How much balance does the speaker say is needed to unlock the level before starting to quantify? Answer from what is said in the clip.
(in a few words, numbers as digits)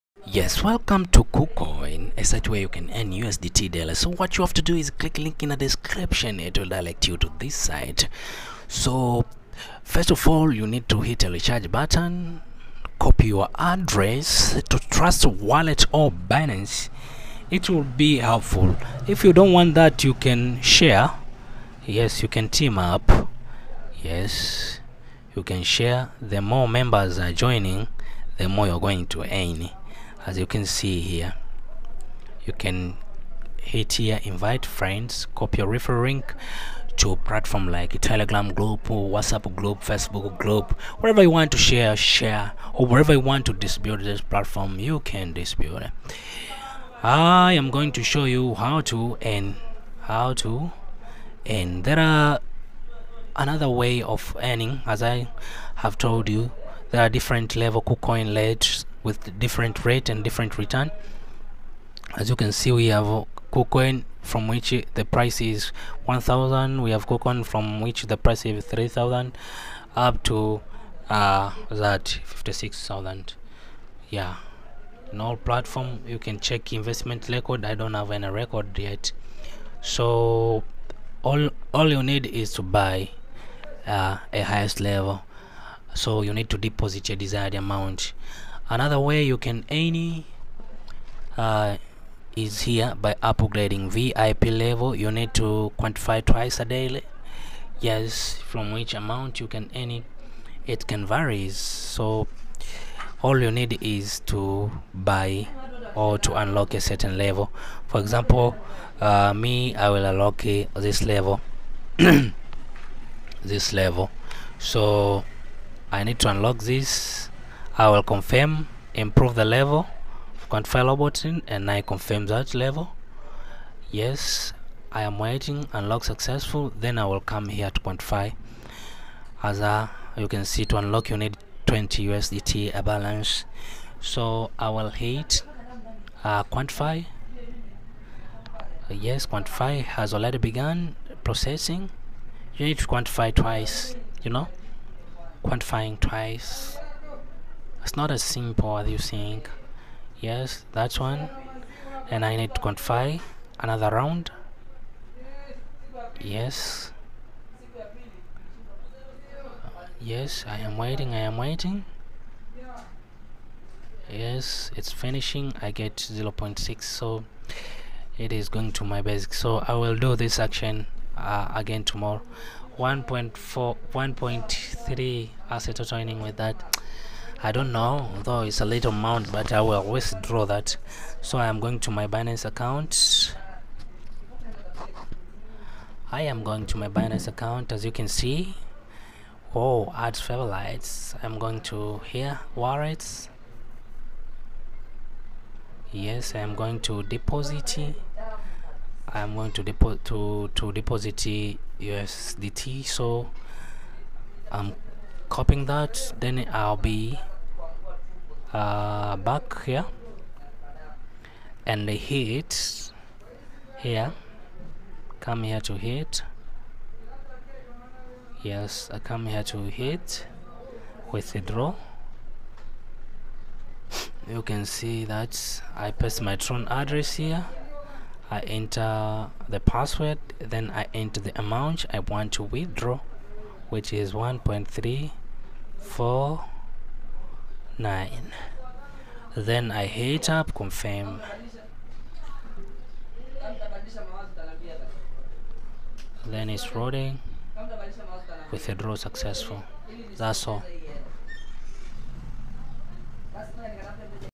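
20 USDT.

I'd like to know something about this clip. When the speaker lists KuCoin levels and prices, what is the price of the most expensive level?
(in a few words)
56,000.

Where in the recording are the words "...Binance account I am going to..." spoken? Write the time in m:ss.
3:02.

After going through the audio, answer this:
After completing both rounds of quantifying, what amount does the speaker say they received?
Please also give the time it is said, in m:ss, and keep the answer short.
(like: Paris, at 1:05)
0.6, at 2:45.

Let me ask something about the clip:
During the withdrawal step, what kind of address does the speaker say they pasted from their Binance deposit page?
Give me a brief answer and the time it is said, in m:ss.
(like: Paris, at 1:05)
Tron, at 3:46.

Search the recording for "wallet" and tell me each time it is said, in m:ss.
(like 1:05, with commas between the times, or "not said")
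0:15, 3:12.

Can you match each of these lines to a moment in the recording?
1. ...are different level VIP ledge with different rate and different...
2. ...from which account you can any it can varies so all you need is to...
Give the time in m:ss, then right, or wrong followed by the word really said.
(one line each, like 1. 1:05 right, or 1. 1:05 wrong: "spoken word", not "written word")
1. 0:57 wrong: "KuCoin", not "VIP"
2. 1:38 wrong: "amount", not "account".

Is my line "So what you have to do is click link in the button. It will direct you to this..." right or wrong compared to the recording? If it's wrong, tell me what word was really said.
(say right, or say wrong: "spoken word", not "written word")
wrong: "description", not "button".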